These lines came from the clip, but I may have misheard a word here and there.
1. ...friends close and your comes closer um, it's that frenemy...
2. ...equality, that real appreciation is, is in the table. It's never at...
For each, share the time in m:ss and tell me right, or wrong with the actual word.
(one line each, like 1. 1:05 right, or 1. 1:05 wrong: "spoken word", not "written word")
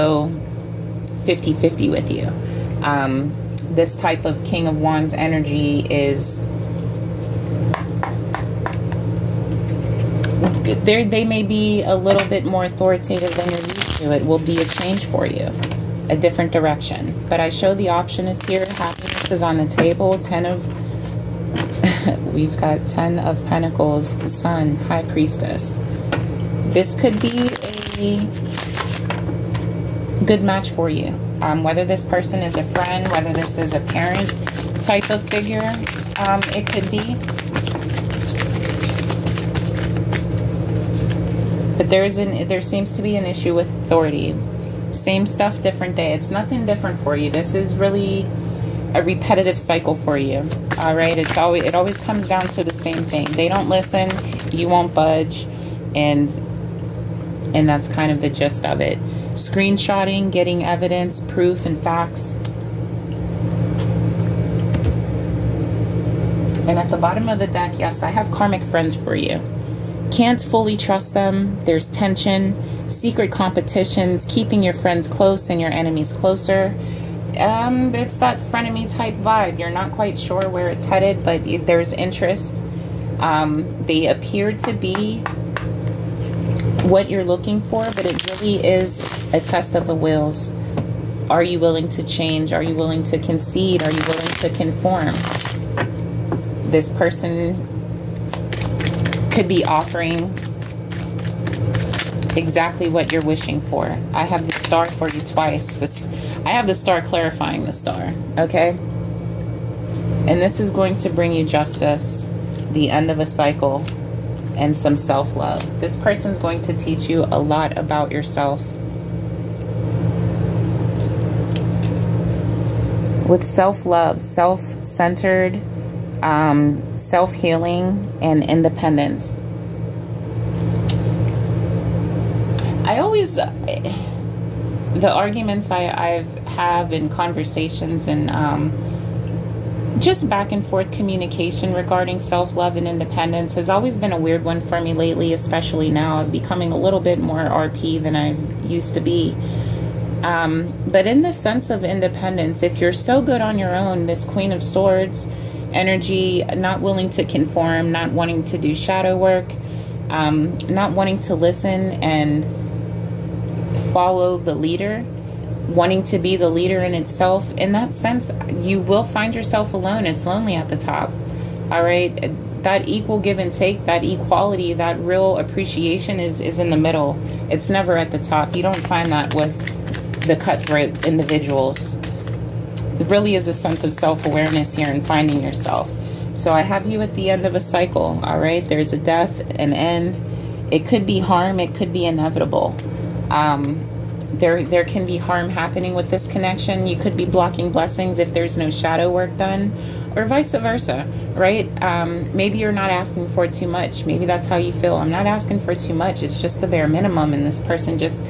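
1. 1:14 wrong: "enemies", not "comes"
2. 2:54 wrong: "middle", not "table".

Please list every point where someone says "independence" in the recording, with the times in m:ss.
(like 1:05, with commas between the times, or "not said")
2:08, 2:22, 2:31.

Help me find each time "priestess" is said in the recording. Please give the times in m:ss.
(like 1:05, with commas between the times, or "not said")
0:25.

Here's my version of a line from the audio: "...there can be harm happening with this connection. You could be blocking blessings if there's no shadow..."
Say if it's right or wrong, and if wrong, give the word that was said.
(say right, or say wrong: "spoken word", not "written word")
right.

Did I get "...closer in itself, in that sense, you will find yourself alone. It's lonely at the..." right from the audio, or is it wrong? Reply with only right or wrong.
wrong.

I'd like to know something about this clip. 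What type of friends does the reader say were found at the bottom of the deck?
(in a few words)
Karmic friends.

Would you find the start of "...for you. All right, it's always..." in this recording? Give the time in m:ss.
0:49.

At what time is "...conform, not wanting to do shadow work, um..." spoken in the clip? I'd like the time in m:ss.
2:37.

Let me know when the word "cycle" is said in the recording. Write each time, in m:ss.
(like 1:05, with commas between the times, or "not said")
0:49, 1:53, 3:07.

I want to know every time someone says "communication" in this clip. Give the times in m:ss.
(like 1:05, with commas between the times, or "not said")
2:20.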